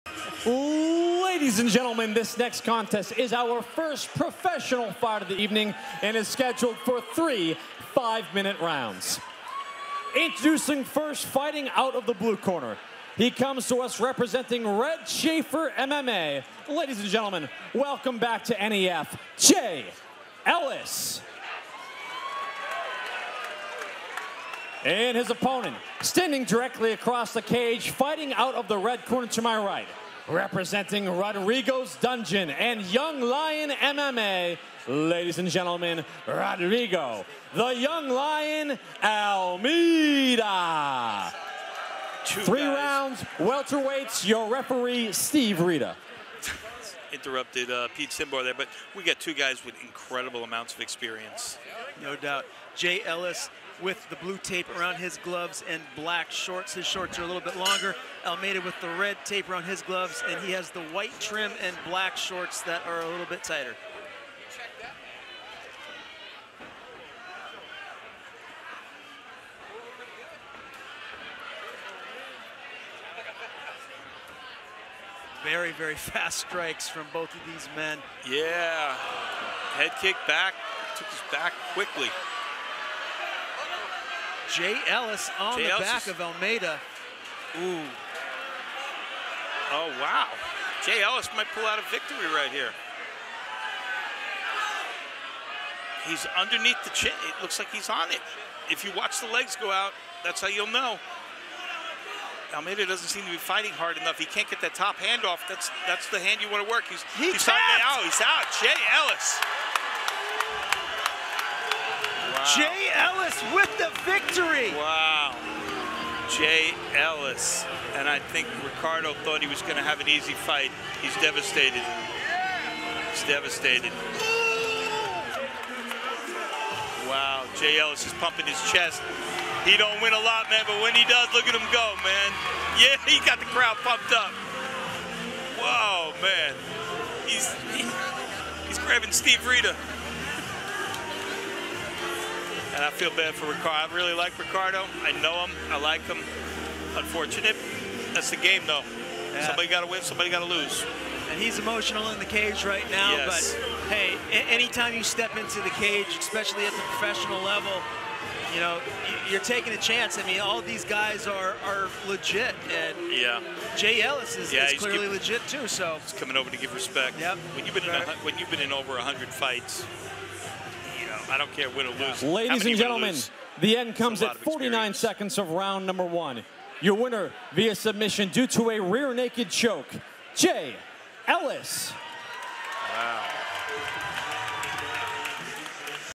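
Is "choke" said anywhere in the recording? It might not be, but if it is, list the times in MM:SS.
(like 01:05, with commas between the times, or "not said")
02:59.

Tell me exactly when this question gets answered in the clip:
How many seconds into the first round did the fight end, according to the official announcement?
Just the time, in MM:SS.
02:54.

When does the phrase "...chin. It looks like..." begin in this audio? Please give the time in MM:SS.
01:36.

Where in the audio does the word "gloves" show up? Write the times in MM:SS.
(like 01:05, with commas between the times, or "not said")
00:55, 00:59.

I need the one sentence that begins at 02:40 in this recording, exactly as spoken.
I mean, all these guys are are legit, and yeah, Jay Ellis is, yeah, is clearly legit too.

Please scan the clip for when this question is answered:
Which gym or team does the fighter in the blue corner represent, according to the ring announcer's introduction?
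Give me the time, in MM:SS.
00:14.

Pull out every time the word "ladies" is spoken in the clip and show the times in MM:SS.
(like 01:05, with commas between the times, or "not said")
00:01, 00:16, 00:34, 02:52.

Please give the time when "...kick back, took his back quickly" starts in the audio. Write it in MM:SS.
01:19.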